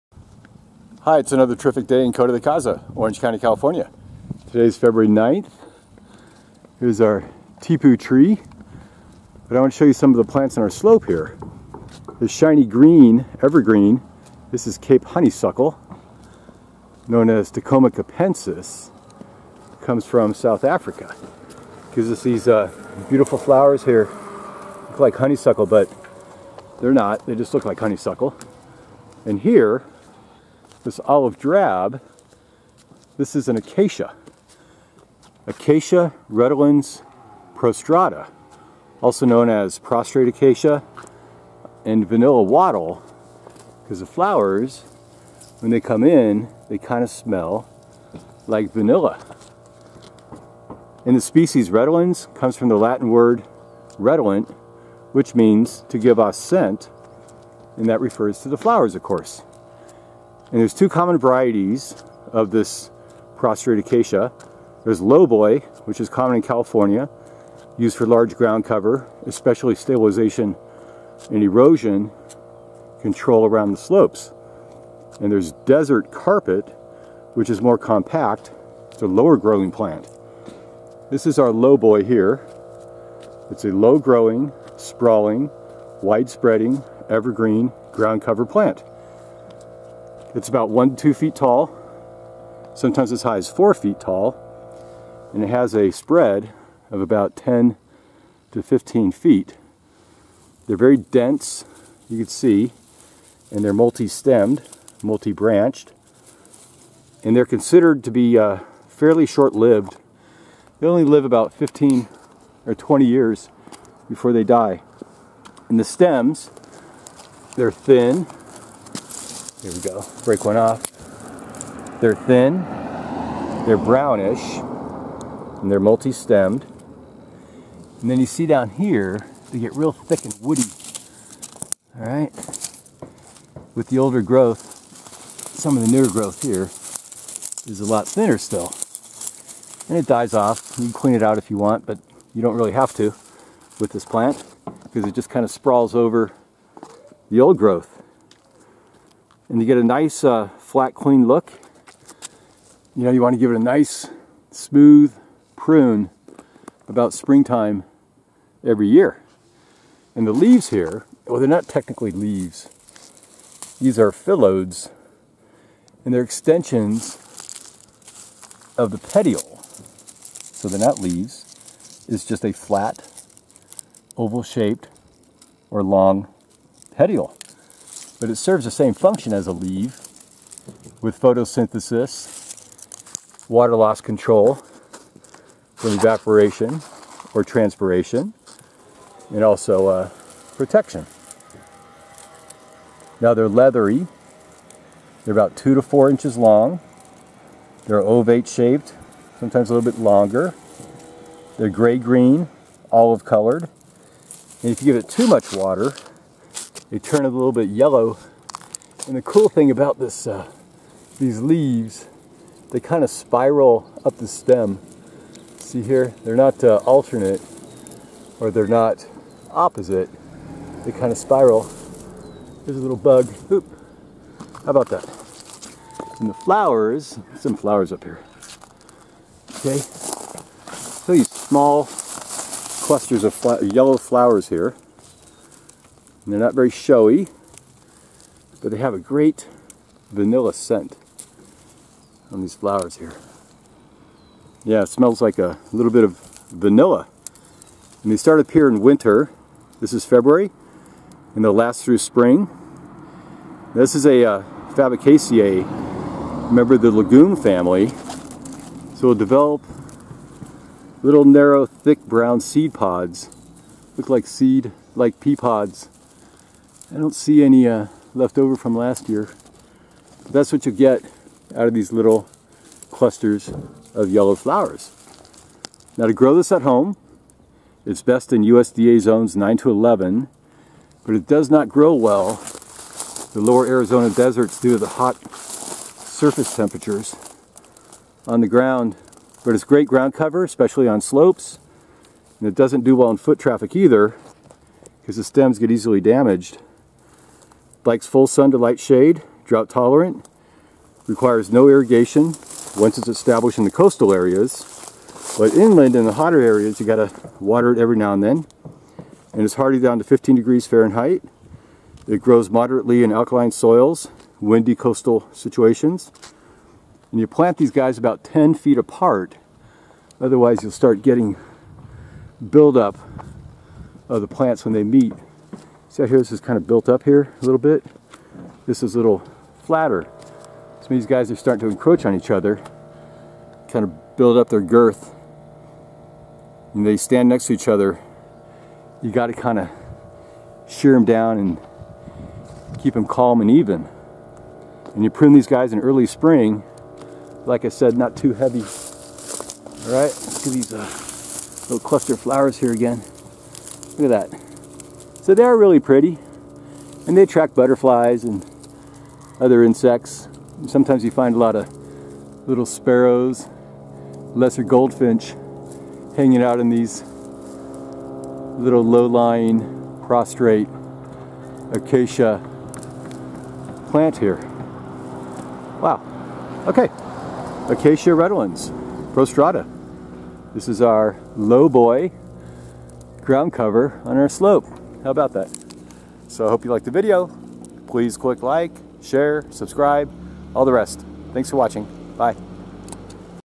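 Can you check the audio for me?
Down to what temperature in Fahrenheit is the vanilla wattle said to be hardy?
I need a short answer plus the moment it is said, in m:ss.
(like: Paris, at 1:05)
15 degrees, at 5:10.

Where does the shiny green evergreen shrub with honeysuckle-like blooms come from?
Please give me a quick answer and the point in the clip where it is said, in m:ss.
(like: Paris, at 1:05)
South Africa, at 0:20.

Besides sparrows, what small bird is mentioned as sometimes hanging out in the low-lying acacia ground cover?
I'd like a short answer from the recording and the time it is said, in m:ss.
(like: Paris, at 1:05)
Lesser goldfinch, at 6:04.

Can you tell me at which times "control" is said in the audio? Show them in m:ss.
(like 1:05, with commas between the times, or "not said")
1:13, 3:03.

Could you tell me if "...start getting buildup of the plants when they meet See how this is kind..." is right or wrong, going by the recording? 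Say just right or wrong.
right.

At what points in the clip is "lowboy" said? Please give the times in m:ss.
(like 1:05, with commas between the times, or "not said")
1:04, 1:21.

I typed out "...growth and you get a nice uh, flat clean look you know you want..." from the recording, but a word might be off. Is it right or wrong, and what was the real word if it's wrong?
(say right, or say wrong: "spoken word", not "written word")
right.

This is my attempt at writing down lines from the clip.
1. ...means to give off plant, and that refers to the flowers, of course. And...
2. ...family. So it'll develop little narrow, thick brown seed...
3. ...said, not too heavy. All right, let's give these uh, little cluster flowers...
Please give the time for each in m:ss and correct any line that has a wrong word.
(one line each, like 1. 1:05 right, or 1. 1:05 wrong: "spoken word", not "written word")
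1. 0:55 wrong: "scent", not "plant"
2. 4:17 right
3. 5:47 right.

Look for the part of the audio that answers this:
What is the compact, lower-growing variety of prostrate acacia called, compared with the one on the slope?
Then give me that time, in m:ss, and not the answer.
1:15.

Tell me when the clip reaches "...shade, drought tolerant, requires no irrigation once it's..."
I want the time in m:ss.
4:58.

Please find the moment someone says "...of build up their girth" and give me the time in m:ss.
5:33.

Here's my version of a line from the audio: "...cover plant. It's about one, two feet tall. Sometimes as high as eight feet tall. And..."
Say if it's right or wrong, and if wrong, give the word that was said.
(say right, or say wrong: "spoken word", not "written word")
wrong: "four", not "eight".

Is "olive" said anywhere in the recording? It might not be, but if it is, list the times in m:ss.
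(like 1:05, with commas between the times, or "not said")
0:31, 3:22.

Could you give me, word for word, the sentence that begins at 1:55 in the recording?
And the stems, they're thin, here we go.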